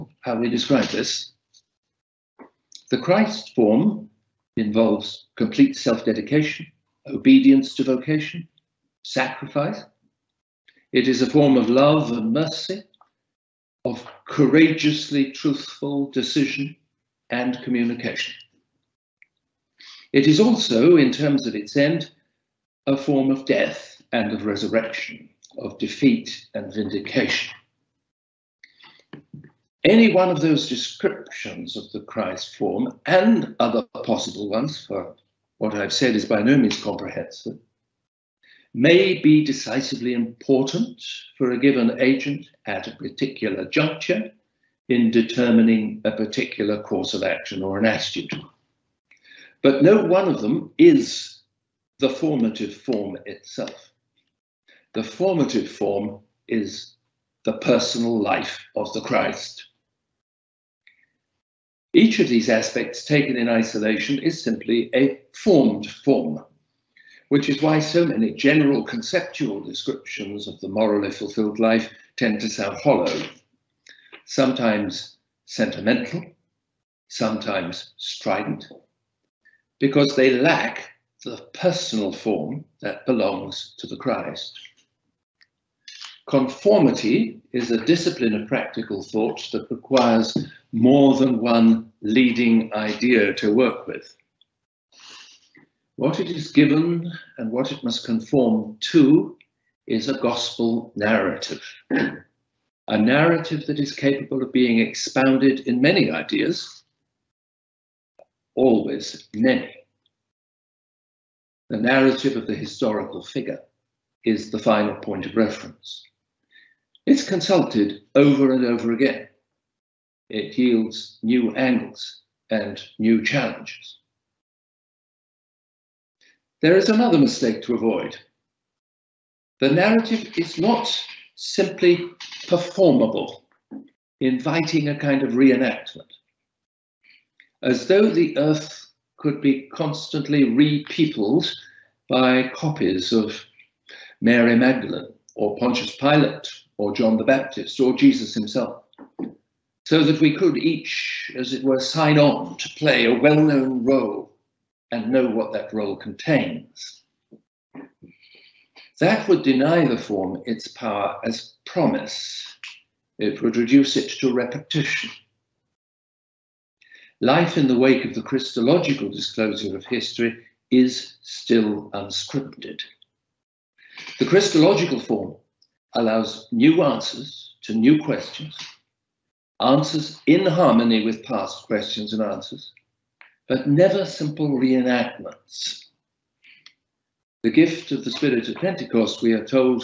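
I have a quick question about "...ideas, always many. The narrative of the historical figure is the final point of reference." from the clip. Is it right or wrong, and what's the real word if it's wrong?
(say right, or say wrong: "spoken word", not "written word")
right.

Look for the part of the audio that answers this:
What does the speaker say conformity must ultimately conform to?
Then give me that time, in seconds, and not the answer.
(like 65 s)
100 s.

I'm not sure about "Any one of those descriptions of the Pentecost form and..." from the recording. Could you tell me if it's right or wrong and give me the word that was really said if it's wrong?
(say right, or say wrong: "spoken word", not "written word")
wrong: "Christ", not "Pentecost".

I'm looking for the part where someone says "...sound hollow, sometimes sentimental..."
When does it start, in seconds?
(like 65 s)
72 s.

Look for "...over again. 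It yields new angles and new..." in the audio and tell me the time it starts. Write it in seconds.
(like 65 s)
118 s.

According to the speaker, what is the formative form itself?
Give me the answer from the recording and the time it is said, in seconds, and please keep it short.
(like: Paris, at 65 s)
The personal life of the Christ, at 57 s.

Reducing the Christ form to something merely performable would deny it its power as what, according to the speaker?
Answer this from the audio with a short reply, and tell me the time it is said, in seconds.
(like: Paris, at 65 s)
Promise, at 161 s.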